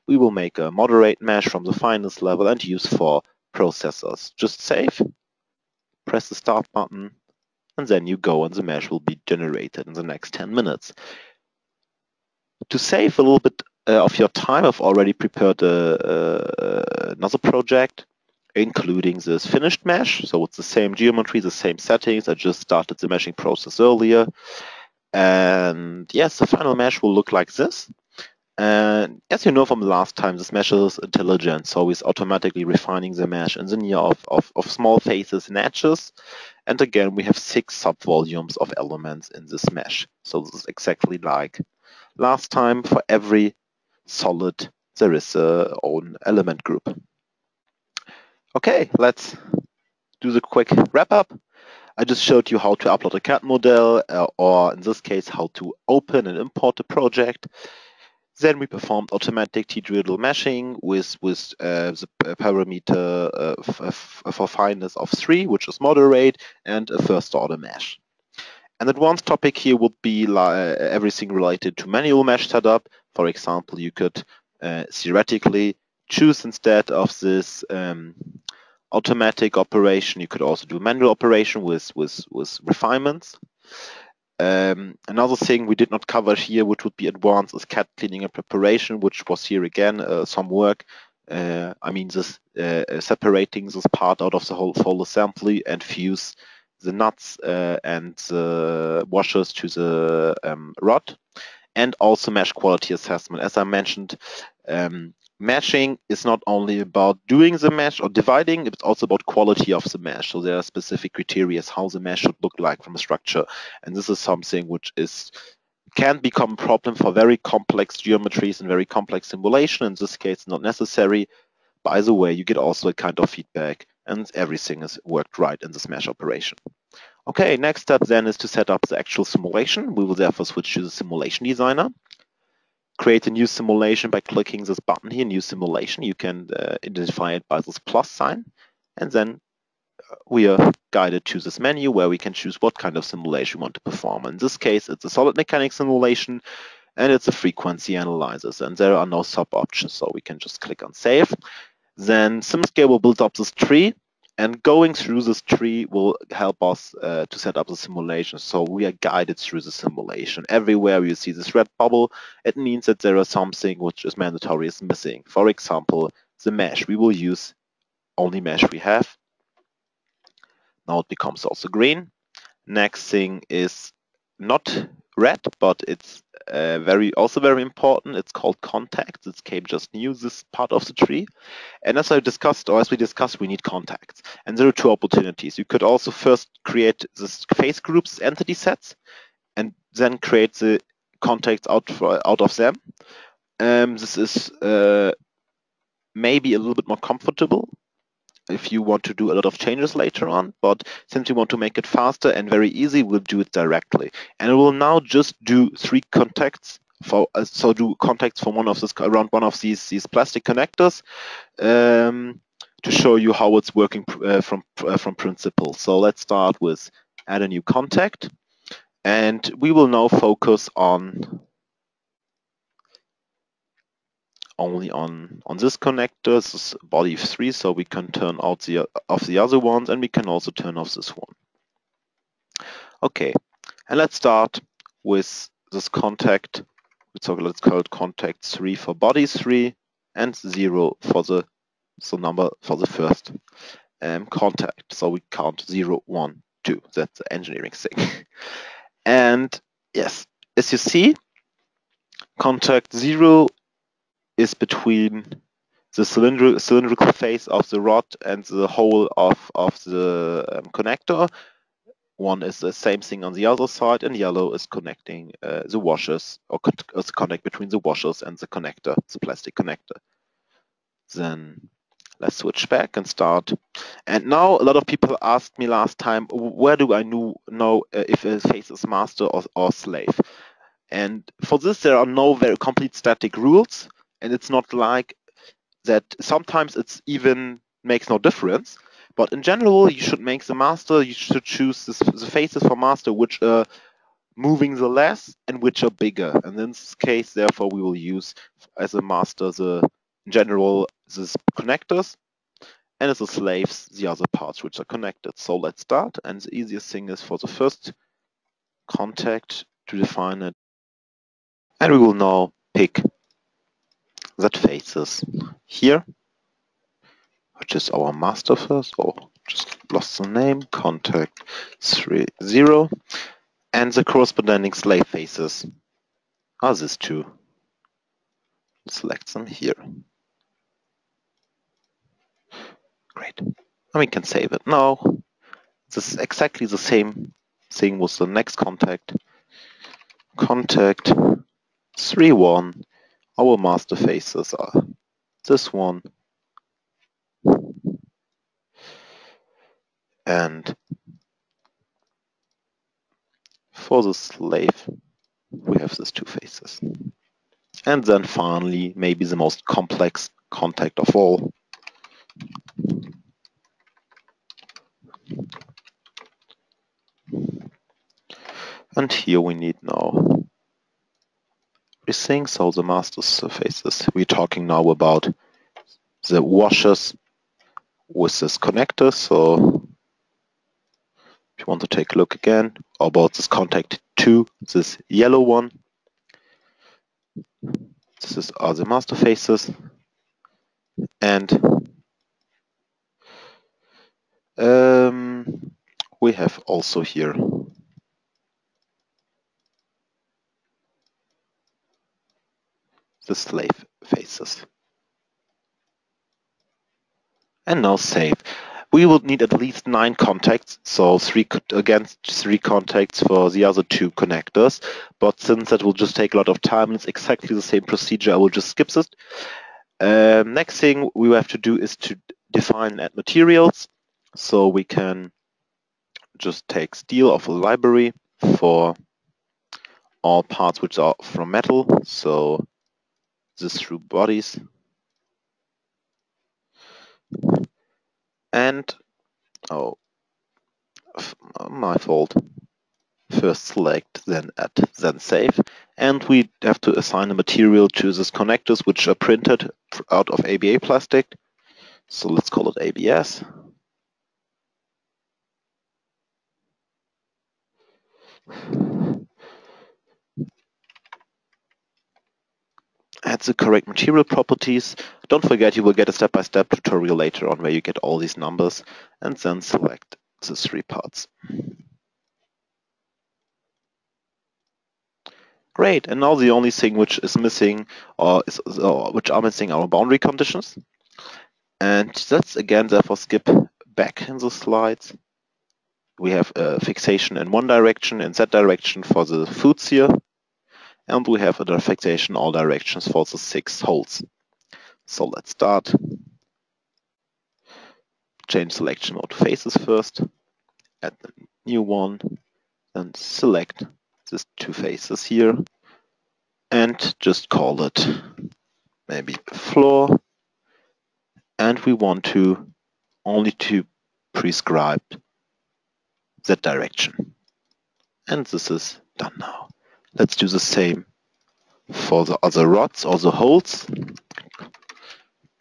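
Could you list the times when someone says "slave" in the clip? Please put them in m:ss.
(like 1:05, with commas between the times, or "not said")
4:39, 5:03, 5:24, 5:54, 6:43.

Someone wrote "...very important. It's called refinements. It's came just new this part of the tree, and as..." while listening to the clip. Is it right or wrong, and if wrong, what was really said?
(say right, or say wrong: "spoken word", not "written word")
wrong: "contacts", not "refinements".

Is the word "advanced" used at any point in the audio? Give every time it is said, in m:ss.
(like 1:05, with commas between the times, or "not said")
1:08, 1:27.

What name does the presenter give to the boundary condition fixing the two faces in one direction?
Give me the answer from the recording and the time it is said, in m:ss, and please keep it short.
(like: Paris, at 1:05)
floor, at 8:29.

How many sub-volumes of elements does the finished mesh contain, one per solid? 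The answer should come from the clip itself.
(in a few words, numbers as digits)
6.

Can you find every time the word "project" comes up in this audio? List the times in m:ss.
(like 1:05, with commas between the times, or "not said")
0:17, 0:56.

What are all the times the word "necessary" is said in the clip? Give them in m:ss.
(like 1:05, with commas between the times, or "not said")
2:00.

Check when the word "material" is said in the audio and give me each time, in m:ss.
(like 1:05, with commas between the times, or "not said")
7:03, 7:27, 7:43.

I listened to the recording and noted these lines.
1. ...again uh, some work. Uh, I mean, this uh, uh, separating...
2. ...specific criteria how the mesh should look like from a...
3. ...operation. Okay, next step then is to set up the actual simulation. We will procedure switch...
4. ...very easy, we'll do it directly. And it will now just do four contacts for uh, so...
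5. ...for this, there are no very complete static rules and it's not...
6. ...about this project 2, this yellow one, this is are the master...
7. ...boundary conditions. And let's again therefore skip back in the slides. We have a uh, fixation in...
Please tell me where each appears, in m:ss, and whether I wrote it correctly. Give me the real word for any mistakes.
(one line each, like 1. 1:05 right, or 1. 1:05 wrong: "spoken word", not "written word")
1. 1:29 right
2. 1:50 right
3. 2:06 wrong: "therefore", not "procedure"
4. 3:22 wrong: "three", not "four"
5. 4:41 right
6. 6:22 wrong: "contact", not "project"
7. 7:59 right.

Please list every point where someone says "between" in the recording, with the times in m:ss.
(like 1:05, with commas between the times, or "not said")
4:14, 4:27.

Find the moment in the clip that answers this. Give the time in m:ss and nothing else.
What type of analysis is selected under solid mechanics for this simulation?
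2:27.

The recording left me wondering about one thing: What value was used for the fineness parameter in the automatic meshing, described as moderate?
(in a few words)
3.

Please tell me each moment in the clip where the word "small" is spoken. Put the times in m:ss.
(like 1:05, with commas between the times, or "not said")
0:34.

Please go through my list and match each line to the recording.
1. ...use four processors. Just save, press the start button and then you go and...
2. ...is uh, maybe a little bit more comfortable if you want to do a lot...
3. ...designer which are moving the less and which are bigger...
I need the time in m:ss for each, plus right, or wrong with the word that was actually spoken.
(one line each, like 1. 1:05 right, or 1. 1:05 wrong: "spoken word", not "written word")
1. 0:02 right
2. 3:14 right
3. 4:52 wrong: "master", not "designer".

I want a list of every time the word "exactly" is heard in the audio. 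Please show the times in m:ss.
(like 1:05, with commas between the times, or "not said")
0:40, 5:36, 6:57.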